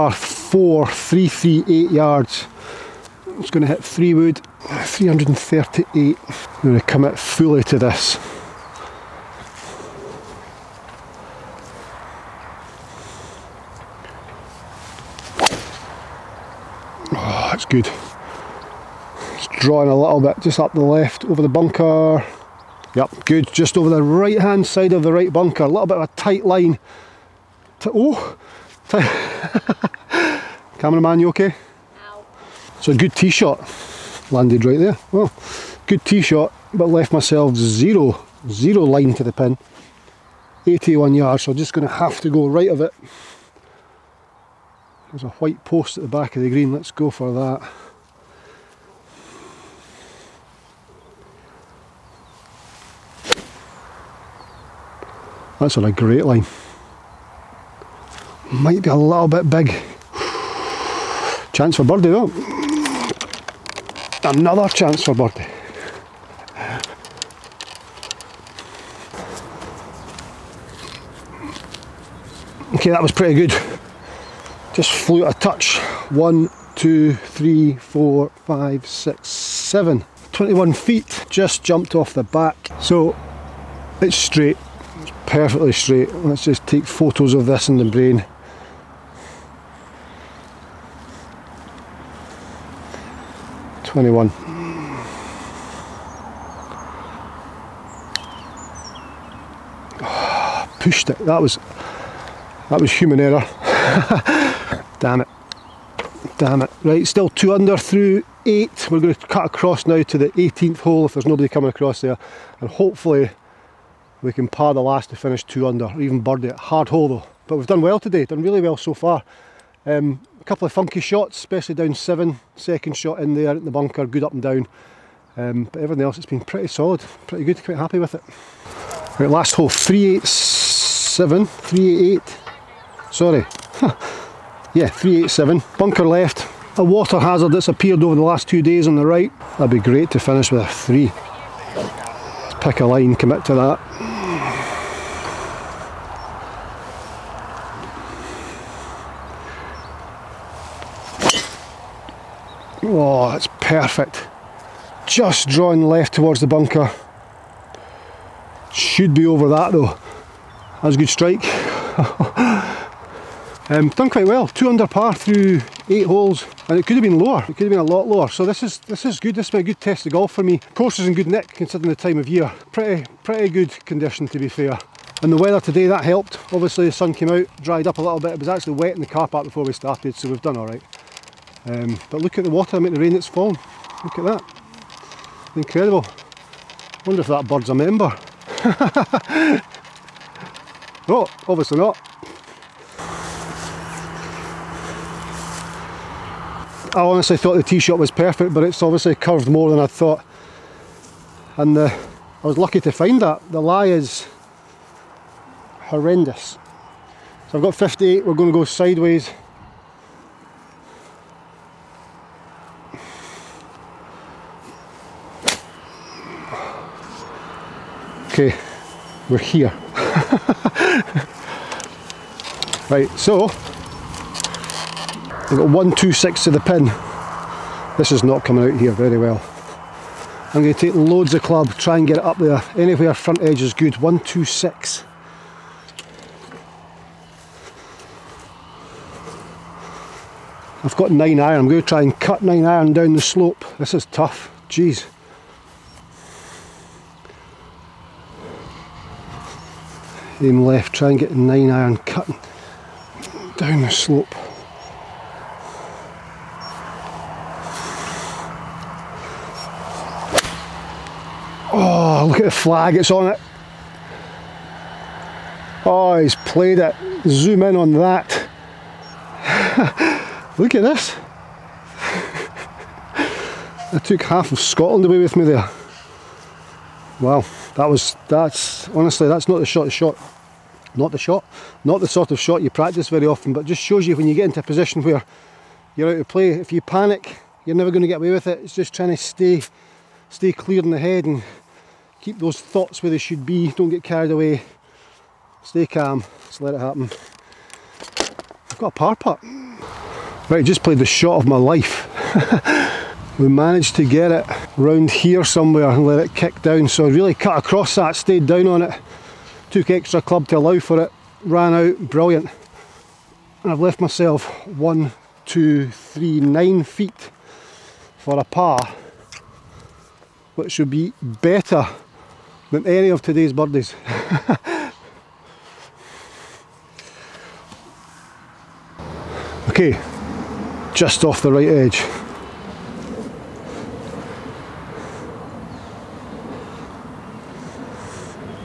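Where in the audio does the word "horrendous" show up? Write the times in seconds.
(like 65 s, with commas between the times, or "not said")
205 s.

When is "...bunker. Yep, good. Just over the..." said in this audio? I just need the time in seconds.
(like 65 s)
21 s.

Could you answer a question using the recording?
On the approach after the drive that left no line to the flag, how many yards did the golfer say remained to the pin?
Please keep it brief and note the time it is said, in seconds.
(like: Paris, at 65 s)
81, at 40 s.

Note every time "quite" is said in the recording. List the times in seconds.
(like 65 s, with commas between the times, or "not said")
127 s, 164 s.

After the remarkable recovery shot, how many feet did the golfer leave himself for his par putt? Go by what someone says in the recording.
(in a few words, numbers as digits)
9.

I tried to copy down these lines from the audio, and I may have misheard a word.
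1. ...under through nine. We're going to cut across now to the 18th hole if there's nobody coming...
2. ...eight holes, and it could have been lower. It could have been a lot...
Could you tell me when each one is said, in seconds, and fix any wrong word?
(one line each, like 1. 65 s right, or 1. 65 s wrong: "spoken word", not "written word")
1. 107 s wrong: "eight", not "nine"
2. 165 s right.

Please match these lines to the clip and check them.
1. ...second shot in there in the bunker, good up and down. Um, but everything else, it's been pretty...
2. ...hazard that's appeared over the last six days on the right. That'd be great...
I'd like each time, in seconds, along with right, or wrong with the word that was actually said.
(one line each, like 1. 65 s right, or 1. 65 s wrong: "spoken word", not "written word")
1. 122 s right
2. 137 s wrong: "two", not "six".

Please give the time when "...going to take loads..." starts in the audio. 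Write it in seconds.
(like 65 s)
230 s.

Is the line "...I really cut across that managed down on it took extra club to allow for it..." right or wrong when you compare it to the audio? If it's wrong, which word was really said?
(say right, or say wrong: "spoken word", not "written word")
wrong: "stayed", not "managed".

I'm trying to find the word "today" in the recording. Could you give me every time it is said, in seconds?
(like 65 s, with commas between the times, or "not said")
117 s, 175 s, 323 s.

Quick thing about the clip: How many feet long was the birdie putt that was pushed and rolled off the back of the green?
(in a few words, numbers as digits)
21.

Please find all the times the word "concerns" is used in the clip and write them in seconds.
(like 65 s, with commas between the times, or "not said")
not said.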